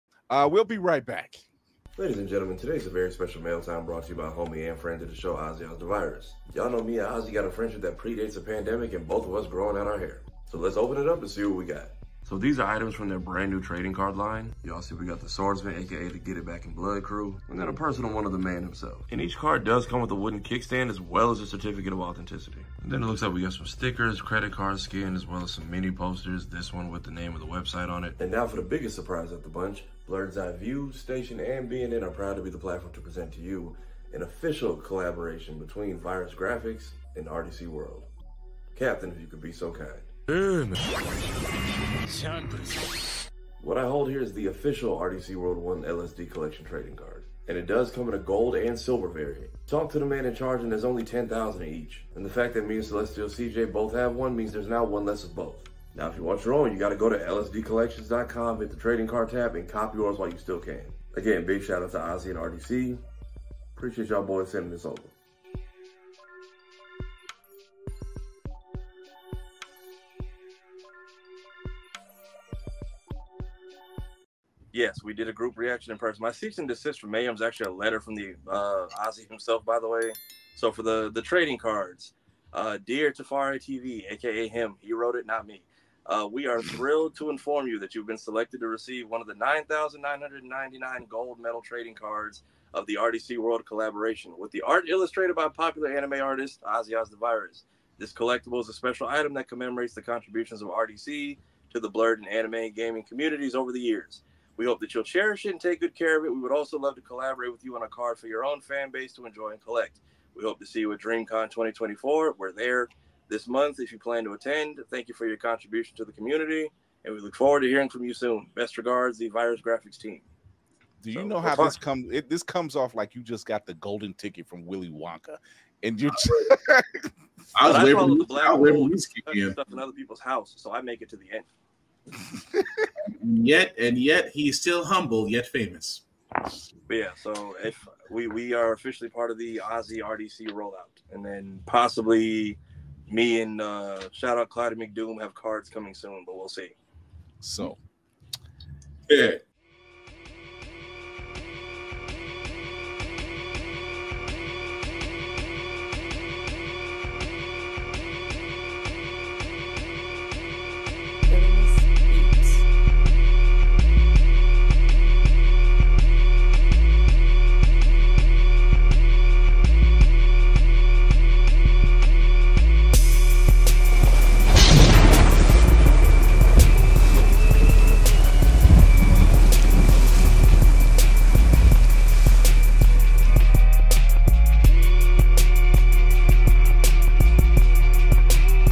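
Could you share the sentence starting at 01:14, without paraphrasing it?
Yes, we did a group reaction in person.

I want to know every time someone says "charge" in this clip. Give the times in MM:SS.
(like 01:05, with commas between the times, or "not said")
00:50.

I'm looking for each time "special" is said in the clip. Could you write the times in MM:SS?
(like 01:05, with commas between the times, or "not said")
00:03, 01:38.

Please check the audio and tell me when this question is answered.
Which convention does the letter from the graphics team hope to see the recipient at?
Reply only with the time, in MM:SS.
01:50.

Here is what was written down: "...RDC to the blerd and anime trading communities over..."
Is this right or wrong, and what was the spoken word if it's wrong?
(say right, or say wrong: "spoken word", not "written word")
wrong: "gaming", not "trading".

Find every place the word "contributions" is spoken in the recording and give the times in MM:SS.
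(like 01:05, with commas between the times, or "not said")
01:40, 01:55.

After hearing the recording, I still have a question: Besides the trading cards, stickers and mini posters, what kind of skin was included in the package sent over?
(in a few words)
credit card skin.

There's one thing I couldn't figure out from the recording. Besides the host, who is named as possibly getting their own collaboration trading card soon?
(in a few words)
Clyde McDoom.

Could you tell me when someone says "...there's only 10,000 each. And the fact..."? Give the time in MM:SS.
00:50.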